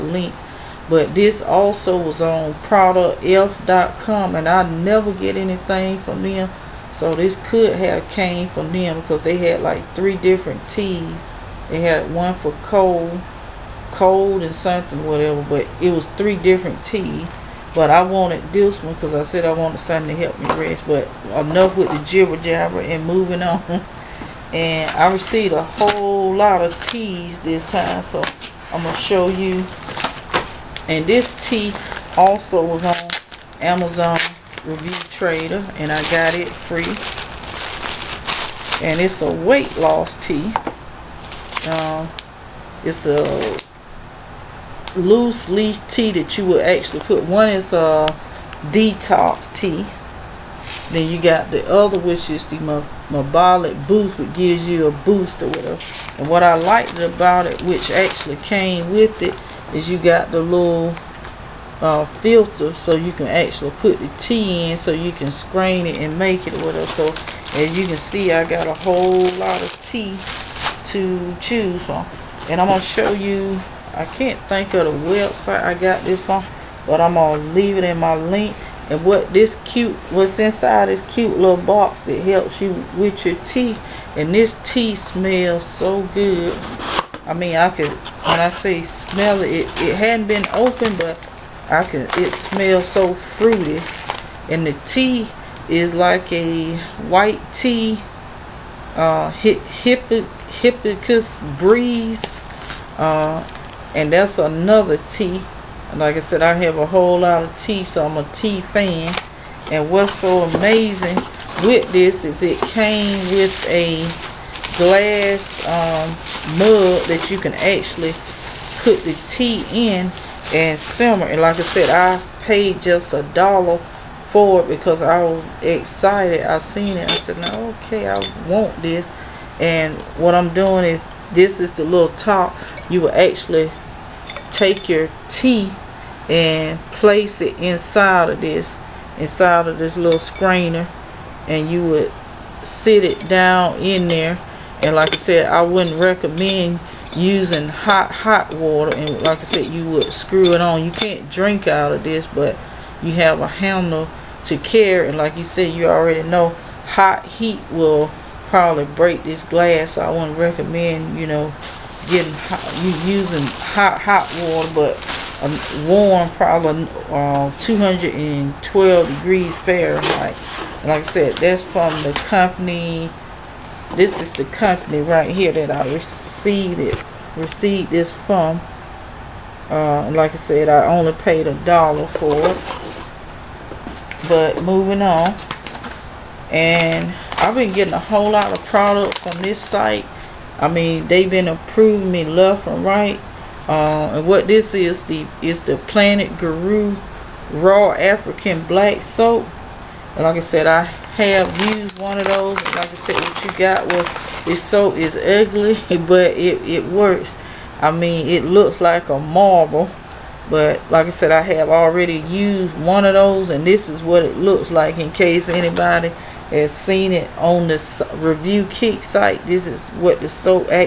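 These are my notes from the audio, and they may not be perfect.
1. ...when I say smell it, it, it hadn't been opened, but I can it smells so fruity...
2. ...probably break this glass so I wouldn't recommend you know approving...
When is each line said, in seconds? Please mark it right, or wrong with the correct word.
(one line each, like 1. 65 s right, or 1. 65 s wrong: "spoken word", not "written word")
1. 87 s right
2. 158 s wrong: "getting", not "approving".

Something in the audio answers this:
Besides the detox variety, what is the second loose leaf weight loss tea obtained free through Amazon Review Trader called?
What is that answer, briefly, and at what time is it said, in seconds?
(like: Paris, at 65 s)
Metabolic boost, at 53 s.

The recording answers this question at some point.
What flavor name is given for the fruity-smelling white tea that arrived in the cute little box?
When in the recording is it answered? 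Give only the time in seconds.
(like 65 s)
99 s.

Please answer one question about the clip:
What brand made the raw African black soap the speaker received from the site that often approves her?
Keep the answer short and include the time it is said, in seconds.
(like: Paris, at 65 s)
Plant Guru, at 195 s.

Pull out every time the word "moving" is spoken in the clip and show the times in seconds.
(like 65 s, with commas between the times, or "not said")
23 s, 184 s.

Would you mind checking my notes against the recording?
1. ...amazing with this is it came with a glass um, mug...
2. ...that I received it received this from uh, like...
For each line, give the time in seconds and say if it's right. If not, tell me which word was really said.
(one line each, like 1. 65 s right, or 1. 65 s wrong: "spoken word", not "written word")
1. 110 s right
2. 175 s right.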